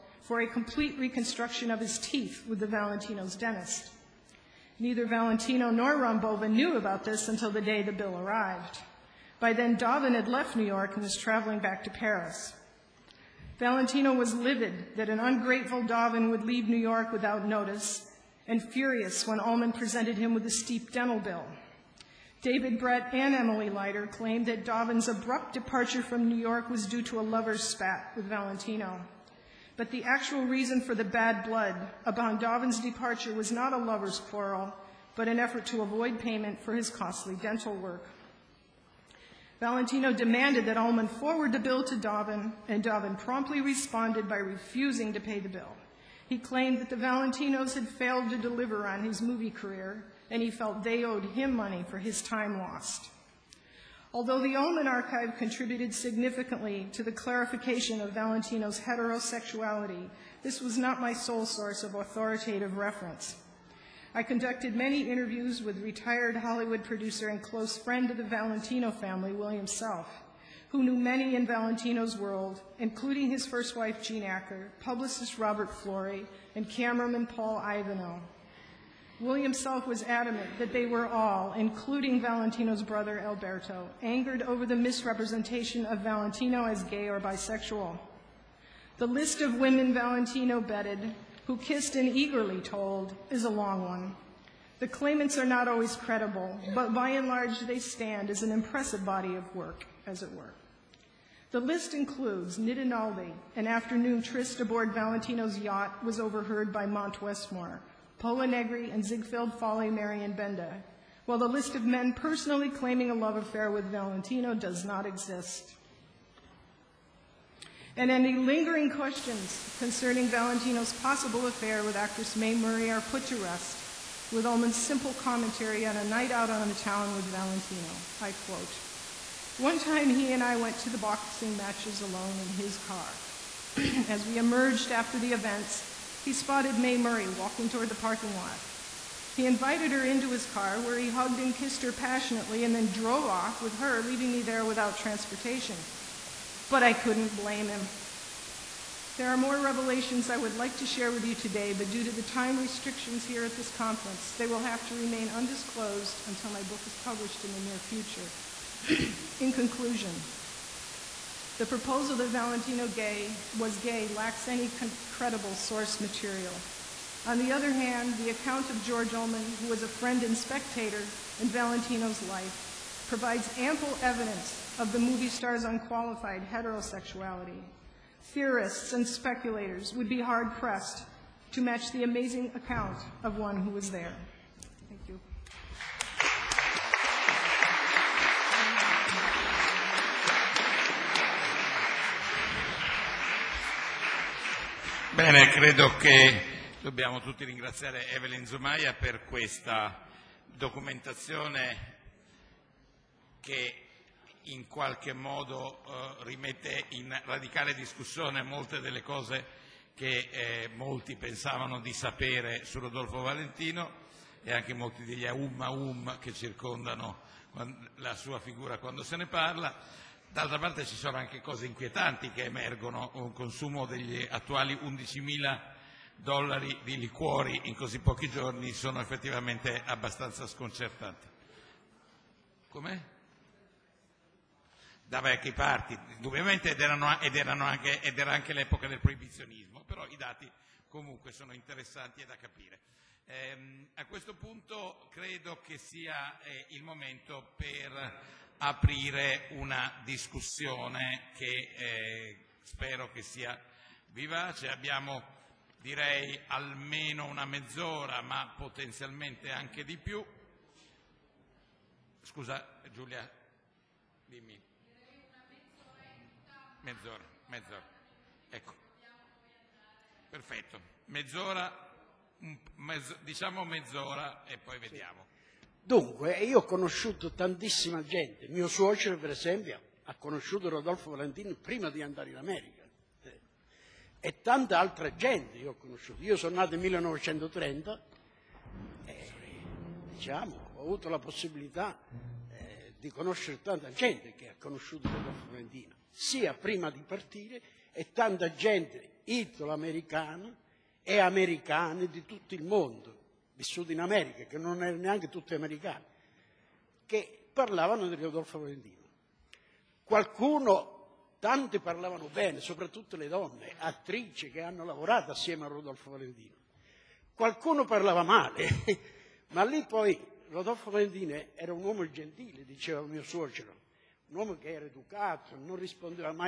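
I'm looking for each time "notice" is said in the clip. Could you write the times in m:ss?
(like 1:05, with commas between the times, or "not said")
0:17.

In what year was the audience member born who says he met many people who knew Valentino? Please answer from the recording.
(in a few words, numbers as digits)
1930.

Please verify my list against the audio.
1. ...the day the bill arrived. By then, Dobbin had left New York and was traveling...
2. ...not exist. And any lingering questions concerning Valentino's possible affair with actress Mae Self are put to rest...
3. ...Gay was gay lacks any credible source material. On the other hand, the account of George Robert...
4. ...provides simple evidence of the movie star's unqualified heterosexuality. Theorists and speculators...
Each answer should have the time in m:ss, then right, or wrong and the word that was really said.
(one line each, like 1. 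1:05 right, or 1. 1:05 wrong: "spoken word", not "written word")
1. 0:07 right
2. 1:54 wrong: "Murray", not "Self"
3. 2:42 wrong: "Ullman", not "Robert"
4. 2:53 wrong: "ample", not "simple".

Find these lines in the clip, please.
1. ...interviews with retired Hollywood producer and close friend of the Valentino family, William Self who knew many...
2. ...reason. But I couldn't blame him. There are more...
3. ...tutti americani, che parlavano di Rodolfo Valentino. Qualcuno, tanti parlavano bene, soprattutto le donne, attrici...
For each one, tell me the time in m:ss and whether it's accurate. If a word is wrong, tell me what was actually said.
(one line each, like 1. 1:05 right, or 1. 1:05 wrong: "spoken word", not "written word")
1. 1:05 right
2. 2:24 wrong: "transportation", not "reason"
3. 5:05 right.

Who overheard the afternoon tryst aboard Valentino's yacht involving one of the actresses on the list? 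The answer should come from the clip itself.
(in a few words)
Monte Westmore.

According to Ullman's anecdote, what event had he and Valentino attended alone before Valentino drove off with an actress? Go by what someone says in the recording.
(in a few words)
boxing matches.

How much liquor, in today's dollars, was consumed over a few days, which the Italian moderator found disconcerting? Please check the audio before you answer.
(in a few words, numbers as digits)
11,000 dollars.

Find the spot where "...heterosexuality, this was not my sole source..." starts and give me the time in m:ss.
0:58.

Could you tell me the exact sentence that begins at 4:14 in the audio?
Abbiamo direi almeno una mezz'ora, ma potenzialmente anche di più.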